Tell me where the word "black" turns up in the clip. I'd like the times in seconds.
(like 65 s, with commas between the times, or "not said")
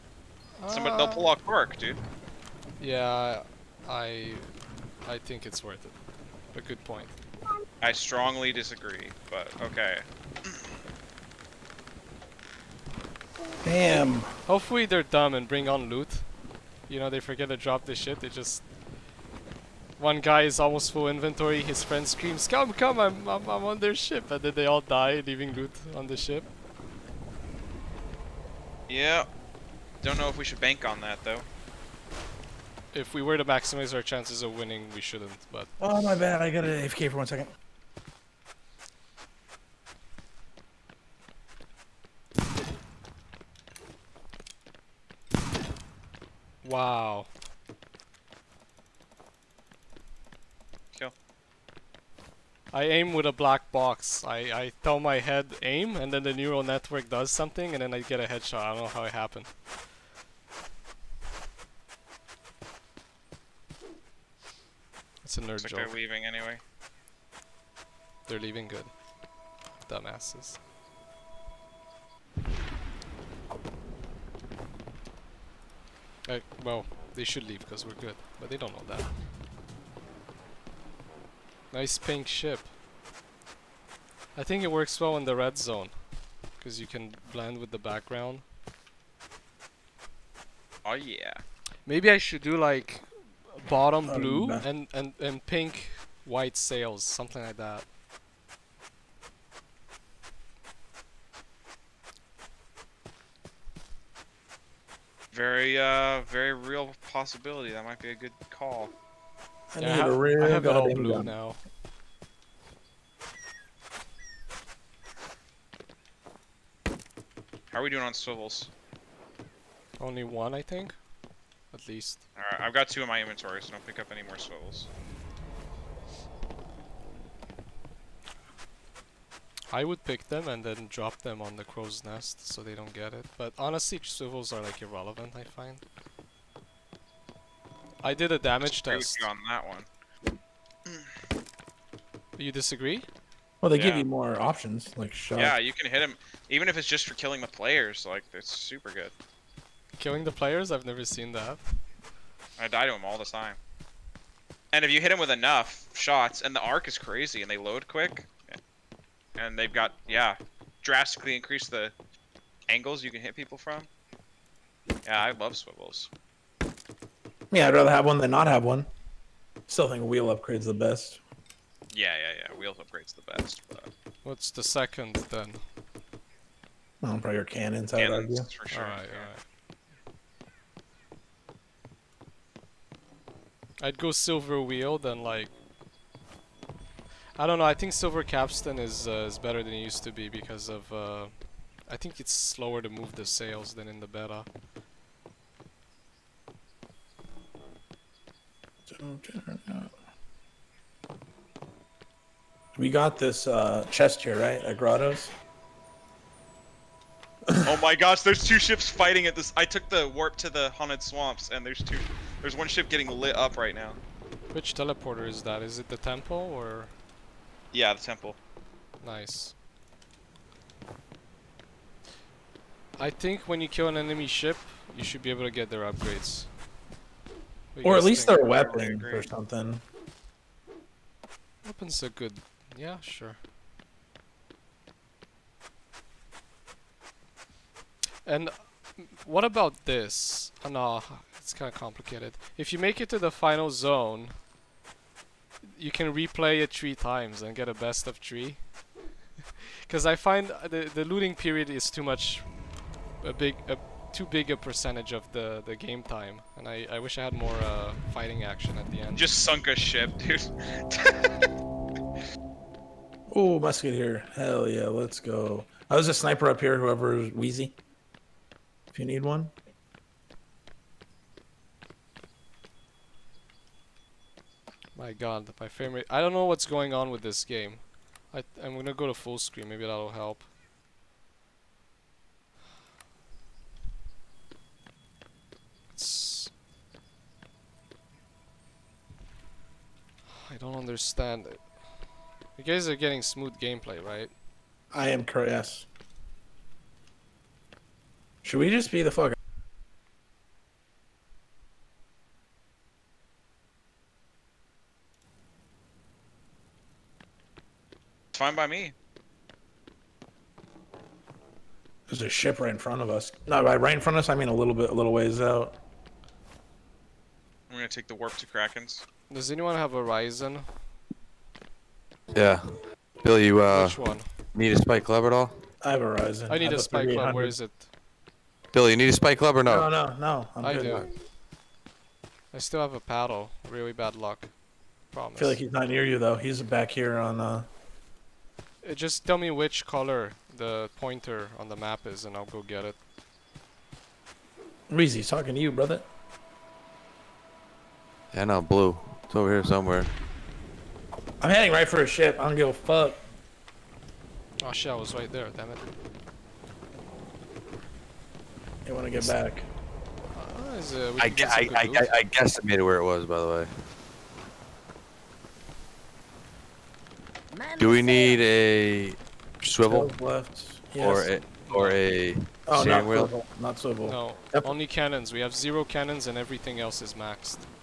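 53 s.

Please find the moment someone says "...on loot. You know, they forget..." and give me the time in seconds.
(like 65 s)
15 s.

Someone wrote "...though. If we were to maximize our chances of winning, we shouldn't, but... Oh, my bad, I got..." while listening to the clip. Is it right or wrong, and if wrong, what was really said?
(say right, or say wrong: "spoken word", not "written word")
right.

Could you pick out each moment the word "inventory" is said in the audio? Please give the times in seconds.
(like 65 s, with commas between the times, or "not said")
21 s, 123 s.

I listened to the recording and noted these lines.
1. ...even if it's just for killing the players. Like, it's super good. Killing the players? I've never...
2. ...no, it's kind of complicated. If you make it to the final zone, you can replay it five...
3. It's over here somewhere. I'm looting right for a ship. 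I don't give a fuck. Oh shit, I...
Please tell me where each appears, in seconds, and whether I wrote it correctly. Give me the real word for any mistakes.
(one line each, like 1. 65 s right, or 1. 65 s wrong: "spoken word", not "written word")
1. 146 s right
2. 240 s wrong: "three", not "five"
3. 349 s wrong: "heading", not "looting".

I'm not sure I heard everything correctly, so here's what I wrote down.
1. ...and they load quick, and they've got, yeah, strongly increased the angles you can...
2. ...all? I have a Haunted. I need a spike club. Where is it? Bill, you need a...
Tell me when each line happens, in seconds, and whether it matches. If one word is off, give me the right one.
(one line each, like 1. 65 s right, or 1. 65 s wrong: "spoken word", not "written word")
1. 157 s wrong: "drastically", not "strongly"
2. 325 s wrong: "Ryzen", not "Haunted".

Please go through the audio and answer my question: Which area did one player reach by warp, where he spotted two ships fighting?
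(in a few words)
Haunted Swamps.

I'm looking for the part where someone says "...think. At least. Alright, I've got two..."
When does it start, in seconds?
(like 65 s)
120 s.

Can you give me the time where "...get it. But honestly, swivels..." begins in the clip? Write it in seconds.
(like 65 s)
132 s.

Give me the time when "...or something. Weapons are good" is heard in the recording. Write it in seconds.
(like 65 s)
229 s.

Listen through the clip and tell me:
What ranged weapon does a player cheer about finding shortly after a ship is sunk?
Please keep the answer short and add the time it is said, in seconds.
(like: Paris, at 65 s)
Musket, at 263 s.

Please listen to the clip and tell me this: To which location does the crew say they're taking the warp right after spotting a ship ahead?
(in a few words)
Krakens.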